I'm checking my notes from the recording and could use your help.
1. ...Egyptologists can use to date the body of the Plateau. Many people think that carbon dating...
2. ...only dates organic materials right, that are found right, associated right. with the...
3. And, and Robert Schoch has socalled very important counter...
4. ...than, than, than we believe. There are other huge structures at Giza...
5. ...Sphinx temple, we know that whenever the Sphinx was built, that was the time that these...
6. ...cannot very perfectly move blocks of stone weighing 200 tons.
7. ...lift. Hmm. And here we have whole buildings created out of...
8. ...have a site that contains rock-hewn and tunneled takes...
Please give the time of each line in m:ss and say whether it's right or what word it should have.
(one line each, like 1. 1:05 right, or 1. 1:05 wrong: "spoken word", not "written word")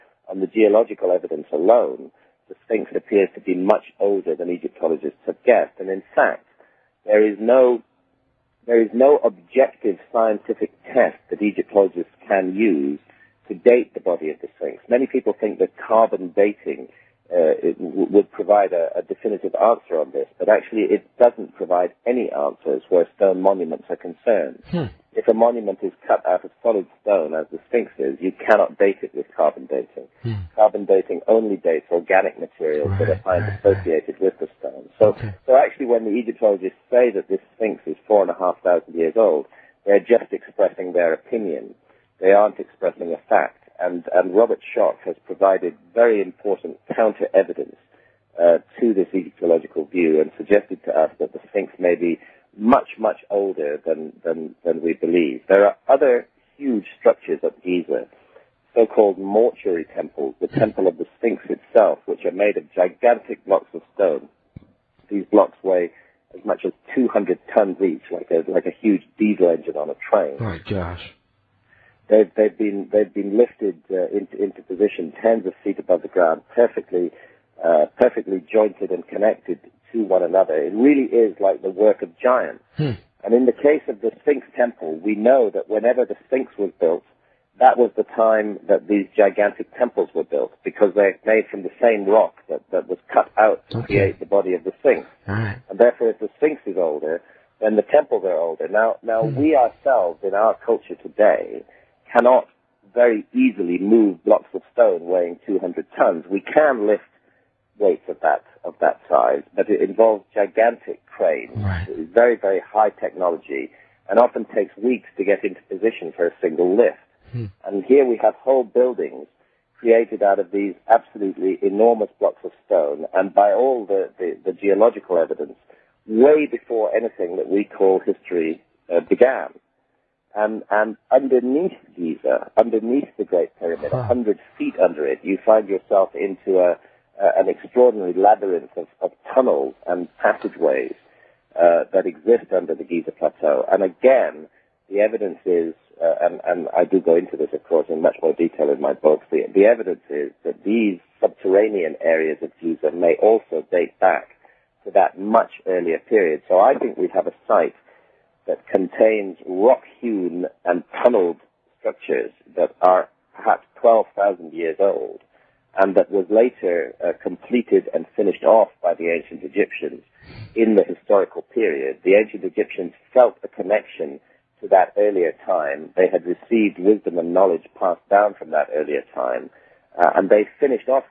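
1. 0:11 wrong: "Sphinx", not "Plateau"
2. 0:31 right
3. 0:43 wrong: "provided", not "socalled"
4. 0:53 right
5. 1:24 right
6. 1:42 wrong: "easily", not "perfectly"
7. 1:56 right
8. 2:37 wrong: "structures", not "takes".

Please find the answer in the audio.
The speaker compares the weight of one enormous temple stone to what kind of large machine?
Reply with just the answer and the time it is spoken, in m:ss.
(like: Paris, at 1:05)
diesel engine, at 1:09.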